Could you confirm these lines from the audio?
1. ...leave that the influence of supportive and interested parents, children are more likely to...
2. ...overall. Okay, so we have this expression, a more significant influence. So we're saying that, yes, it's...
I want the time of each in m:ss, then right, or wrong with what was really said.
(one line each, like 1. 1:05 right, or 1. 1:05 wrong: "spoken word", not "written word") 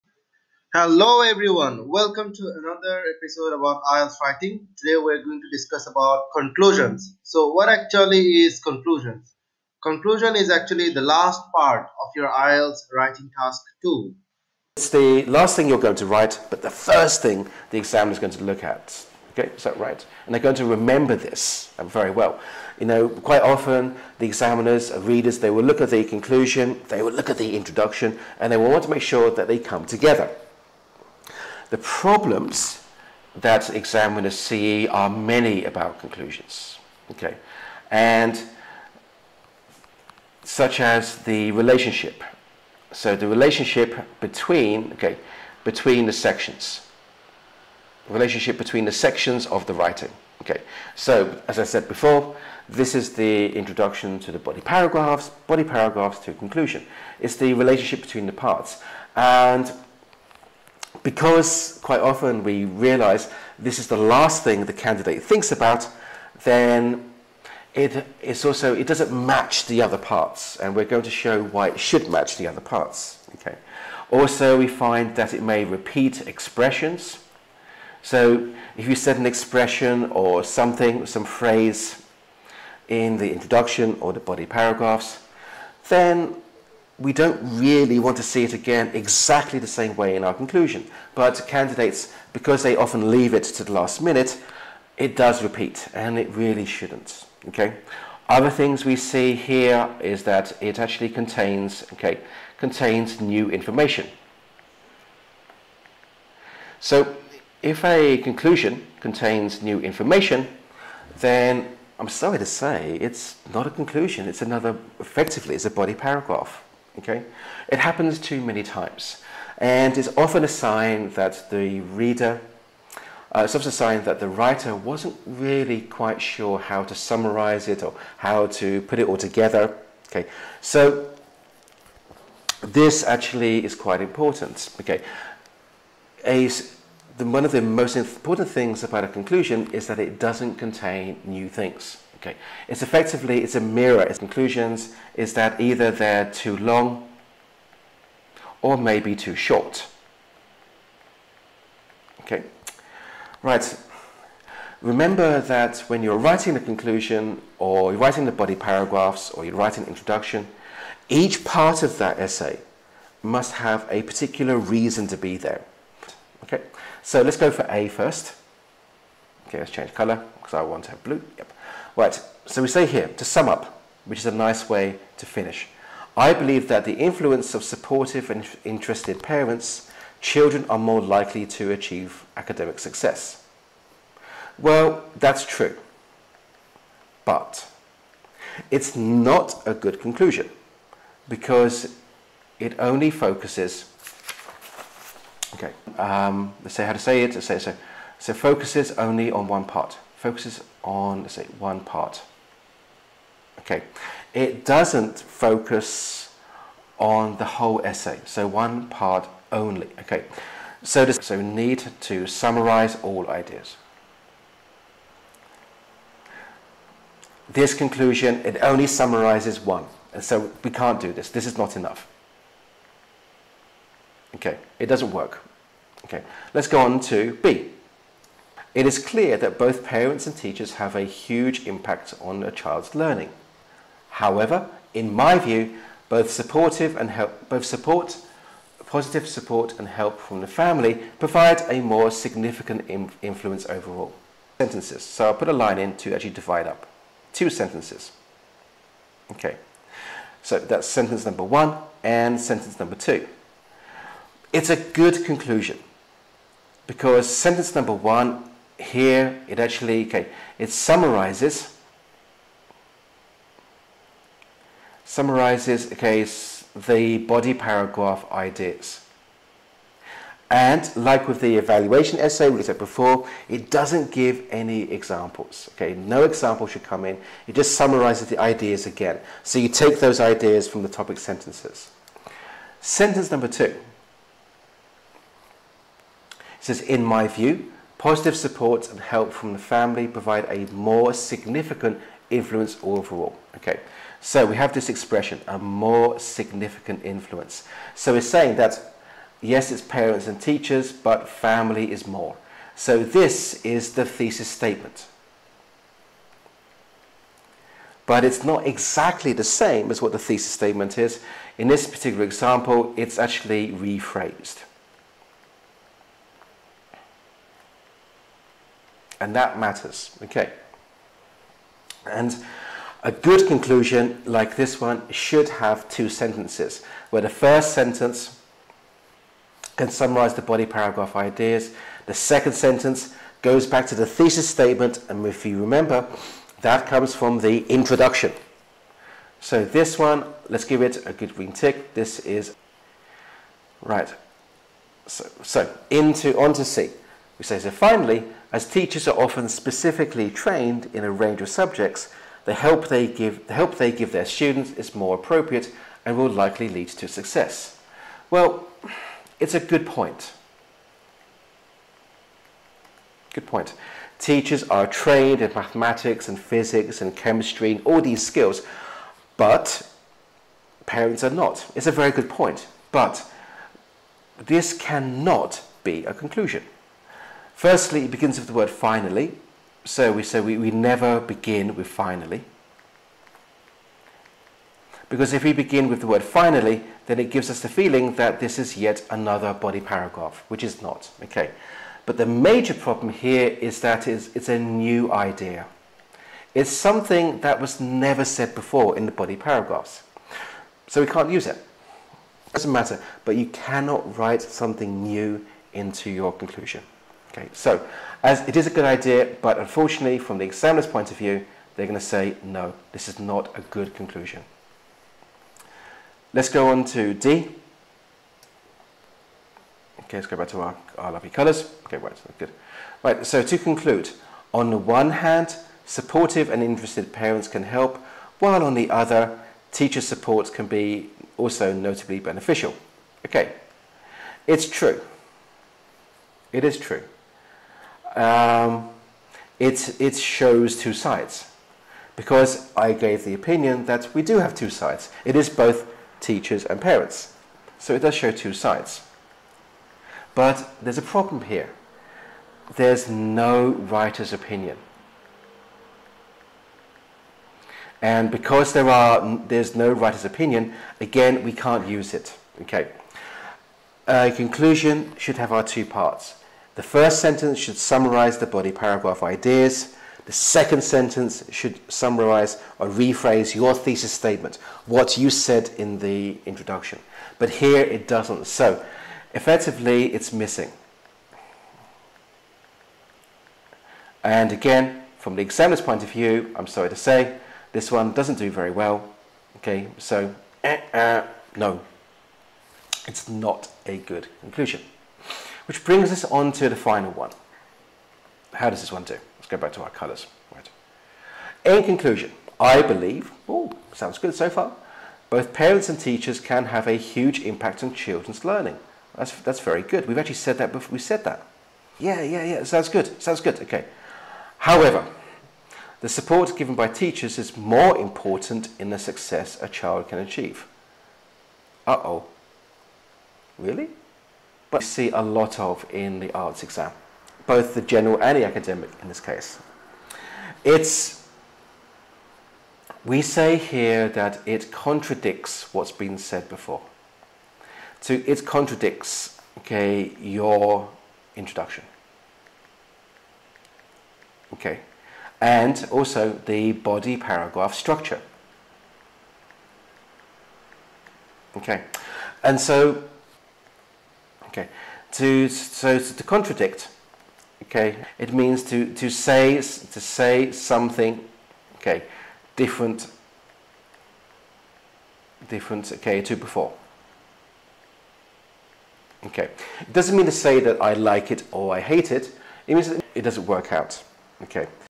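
1. 2:56 wrong: "believe", not "leave"
2. 4:52 right.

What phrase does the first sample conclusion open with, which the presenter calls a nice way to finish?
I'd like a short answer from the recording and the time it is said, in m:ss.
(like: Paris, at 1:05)
To sum up, at 2:53.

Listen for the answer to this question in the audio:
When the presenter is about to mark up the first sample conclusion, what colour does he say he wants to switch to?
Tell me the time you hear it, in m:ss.
2:51.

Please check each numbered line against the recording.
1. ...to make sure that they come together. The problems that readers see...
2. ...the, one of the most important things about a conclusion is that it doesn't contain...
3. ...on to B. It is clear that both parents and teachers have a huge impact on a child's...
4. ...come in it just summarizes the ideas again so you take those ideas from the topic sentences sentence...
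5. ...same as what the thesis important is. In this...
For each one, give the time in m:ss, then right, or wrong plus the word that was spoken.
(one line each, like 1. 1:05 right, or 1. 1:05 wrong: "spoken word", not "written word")
1. 0:28 wrong: "examiners", not "readers"
2. 2:17 right
3. 3:46 right
4. 4:36 right
5. 5:09 wrong: "statement", not "important".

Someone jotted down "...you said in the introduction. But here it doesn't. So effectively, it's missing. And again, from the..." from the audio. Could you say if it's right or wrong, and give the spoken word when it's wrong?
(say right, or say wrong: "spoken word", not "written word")
right.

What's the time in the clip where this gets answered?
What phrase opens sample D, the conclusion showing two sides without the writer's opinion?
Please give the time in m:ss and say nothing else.
7:03.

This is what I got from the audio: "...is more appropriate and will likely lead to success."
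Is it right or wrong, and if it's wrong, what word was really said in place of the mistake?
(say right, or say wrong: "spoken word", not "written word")
right.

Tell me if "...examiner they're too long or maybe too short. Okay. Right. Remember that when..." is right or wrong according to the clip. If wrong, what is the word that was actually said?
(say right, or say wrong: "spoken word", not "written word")
wrong: "either", not "examiner".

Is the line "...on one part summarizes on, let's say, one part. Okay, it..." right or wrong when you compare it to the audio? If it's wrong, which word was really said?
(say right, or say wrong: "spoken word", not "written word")
wrong: "focuses", not "summarizes".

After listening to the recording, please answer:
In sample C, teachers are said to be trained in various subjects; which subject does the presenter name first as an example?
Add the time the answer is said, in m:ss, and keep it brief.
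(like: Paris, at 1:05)
mathematics, at 6:05.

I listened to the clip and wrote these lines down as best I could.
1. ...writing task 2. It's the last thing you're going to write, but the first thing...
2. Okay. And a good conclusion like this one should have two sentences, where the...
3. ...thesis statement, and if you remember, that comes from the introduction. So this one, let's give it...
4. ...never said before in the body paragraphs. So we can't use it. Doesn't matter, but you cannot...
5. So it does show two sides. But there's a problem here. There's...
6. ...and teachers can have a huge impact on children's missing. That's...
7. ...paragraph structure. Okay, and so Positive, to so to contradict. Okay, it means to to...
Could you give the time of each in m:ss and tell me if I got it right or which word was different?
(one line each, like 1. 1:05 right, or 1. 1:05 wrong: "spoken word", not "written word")
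1. 0:12 right
2. 5:20 right
3. 5:34 right
4. 6:37 right
5. 7:27 right
6. 8:25 wrong: "learning", not "missing"
7. 9:07 wrong: "Okay", not "Positive".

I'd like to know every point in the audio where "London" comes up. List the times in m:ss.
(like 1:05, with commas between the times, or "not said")
not said.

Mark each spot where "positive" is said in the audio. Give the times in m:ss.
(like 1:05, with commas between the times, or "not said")
3:58, 4:48.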